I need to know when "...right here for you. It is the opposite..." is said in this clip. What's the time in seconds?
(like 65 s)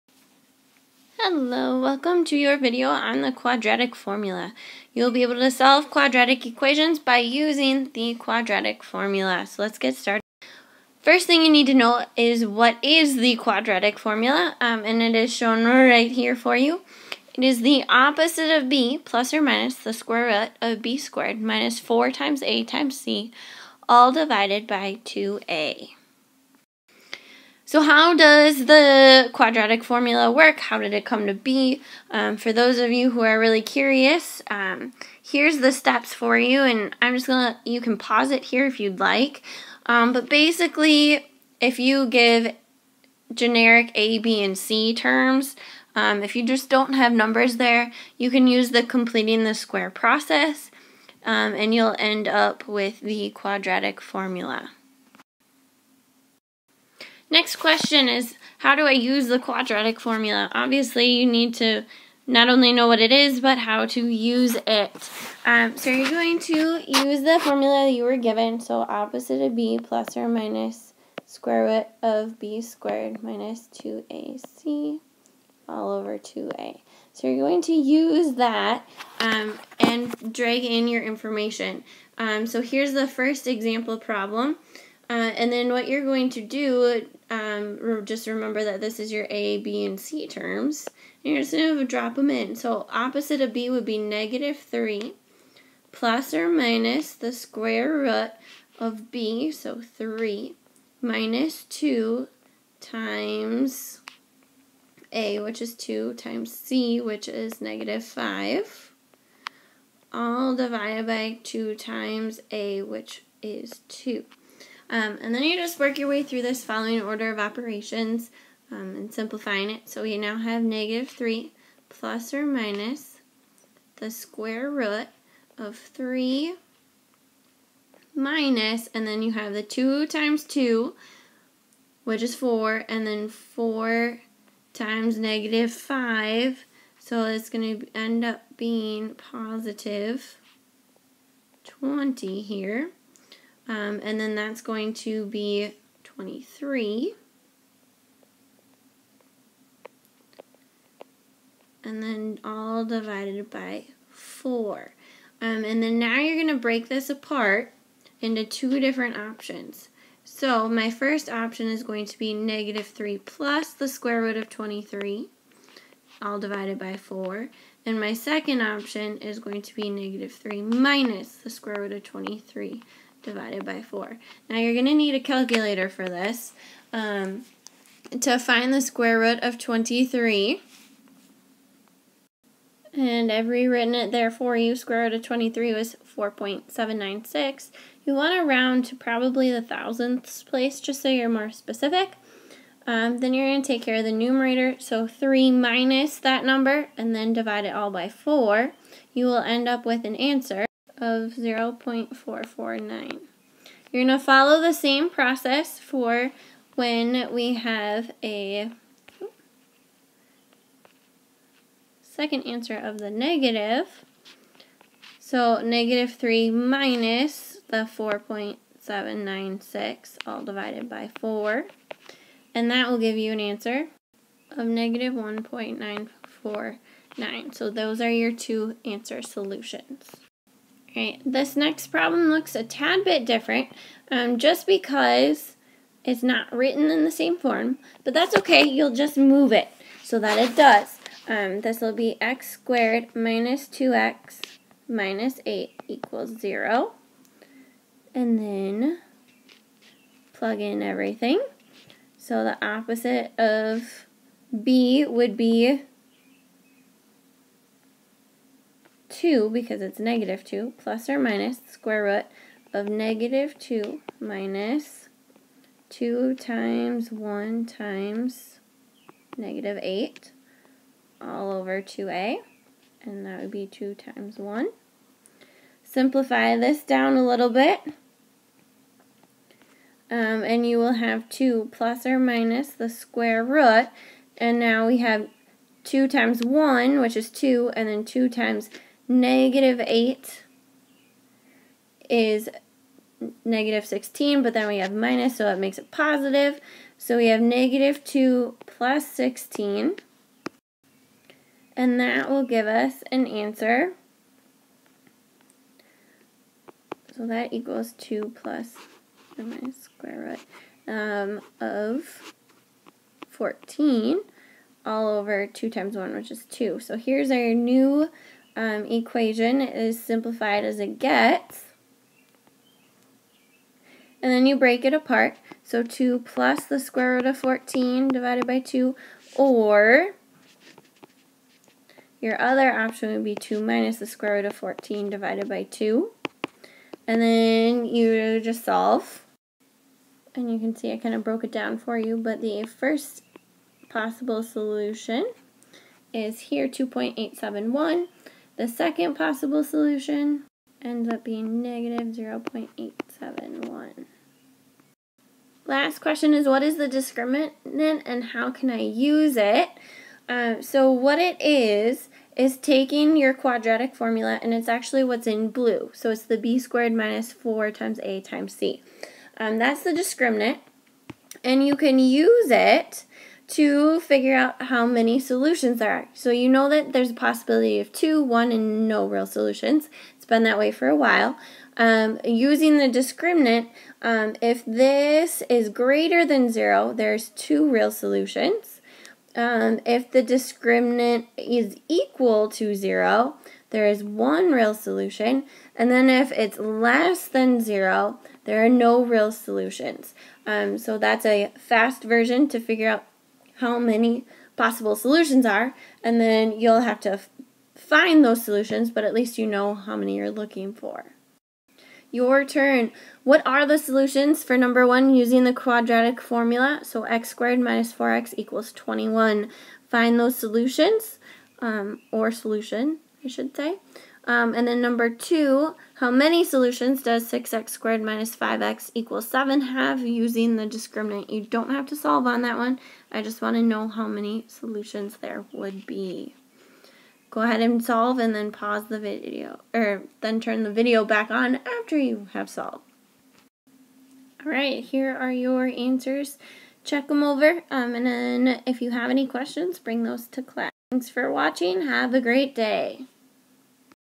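15 s.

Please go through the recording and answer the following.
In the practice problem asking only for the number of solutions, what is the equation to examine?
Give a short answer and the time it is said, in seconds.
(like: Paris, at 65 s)
6x^2 - 5x = 7, at 427 s.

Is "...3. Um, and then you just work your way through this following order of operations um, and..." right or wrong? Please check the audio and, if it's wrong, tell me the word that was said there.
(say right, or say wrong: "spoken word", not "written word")
wrong: "2", not "3".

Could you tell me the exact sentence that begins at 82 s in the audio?
Um, so here's the first example problem.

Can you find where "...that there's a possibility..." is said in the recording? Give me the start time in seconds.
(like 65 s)
376 s.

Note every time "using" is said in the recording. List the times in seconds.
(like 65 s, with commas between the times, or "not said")
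7 s, 382 s, 415 s, 430 s.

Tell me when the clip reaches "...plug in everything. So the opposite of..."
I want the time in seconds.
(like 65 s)
250 s.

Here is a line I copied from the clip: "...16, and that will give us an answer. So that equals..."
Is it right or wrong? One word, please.
right.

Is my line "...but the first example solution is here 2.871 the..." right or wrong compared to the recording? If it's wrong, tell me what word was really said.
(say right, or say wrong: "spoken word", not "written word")
wrong: "possible", not "example".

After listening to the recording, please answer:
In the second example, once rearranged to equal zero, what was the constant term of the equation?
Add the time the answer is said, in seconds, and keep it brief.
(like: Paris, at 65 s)
-8, at 244 s.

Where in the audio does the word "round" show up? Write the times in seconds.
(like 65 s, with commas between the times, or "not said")
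188 s.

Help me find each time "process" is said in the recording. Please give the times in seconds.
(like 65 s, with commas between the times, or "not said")
49 s, 205 s.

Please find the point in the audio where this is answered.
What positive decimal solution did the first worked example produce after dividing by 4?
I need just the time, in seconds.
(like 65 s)
201 s.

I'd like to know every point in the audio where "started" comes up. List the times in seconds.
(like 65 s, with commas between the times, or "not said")
9 s.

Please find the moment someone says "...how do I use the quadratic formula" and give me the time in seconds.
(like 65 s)
58 s.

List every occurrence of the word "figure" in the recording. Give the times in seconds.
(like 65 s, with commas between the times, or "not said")
373 s, 402 s.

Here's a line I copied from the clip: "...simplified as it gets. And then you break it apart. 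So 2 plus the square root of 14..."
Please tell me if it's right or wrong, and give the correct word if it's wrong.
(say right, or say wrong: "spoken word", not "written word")
right.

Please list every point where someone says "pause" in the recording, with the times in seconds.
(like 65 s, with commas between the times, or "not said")
37 s, 438 s.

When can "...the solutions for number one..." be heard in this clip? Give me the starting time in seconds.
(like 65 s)
413 s.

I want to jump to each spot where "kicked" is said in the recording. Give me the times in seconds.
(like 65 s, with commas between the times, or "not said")
not said.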